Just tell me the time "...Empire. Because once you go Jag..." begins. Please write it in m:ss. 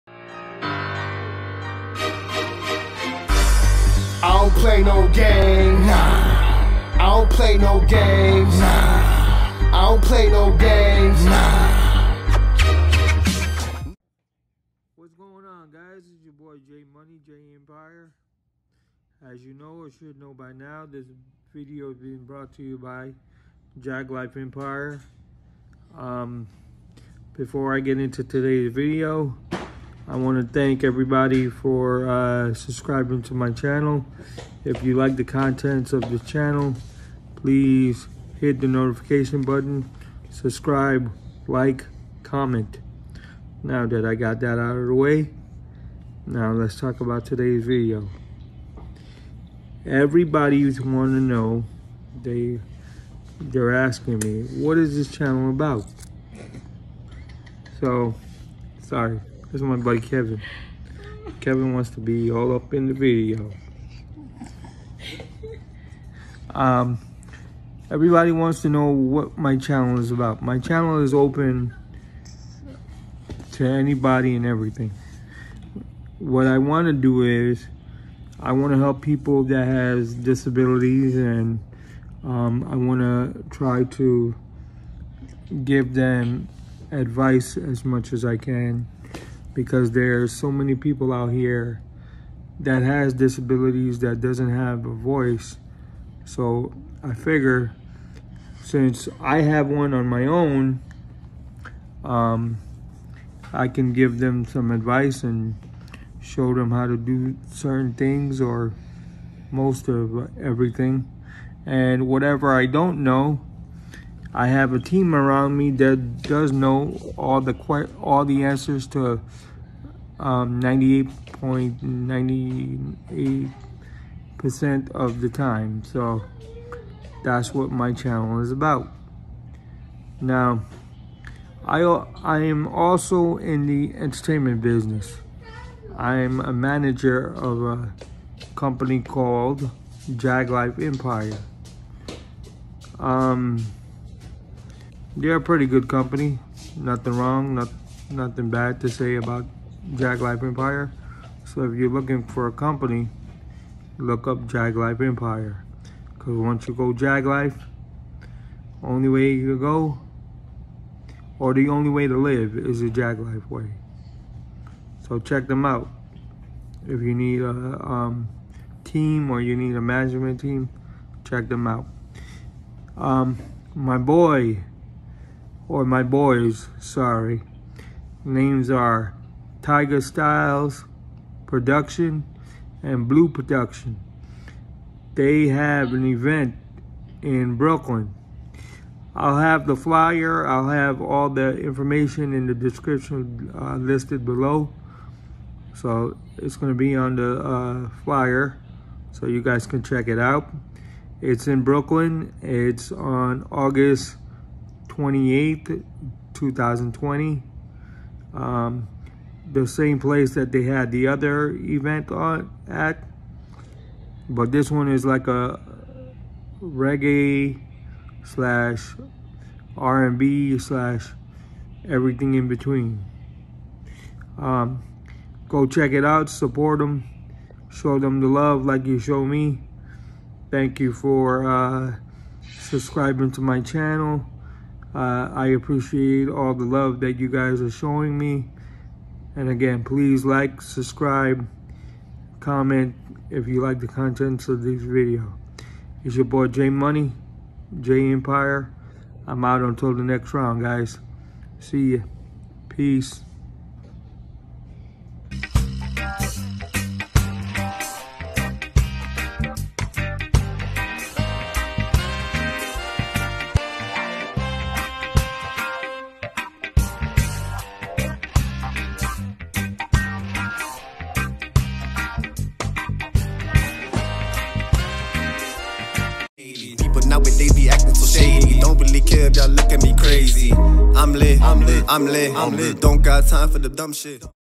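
2:34.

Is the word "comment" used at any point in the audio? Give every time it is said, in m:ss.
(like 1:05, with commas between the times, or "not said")
0:42, 4:02.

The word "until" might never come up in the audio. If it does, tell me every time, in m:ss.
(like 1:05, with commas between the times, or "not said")
4:09.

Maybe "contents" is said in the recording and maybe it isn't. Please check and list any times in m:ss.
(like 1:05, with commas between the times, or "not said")
0:35, 4:03.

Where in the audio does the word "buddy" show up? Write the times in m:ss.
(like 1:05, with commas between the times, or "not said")
0:59.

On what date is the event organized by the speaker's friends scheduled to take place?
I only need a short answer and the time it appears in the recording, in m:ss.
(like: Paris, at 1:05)
August 28, 2020, at 3:23.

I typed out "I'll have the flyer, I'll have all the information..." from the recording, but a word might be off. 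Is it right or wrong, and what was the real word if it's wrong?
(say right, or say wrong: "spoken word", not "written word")
right.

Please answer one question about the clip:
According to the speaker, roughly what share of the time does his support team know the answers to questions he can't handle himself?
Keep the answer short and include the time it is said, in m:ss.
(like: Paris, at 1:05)
98.98%, at 2:00.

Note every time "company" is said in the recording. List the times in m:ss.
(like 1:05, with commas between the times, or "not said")
2:18, 2:25, 2:32.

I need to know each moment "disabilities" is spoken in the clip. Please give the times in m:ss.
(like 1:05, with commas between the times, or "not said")
1:20, 1:33.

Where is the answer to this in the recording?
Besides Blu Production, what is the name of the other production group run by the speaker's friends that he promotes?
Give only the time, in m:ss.
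2:59.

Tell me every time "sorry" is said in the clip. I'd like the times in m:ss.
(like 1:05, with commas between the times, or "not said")
0:58, 2:56.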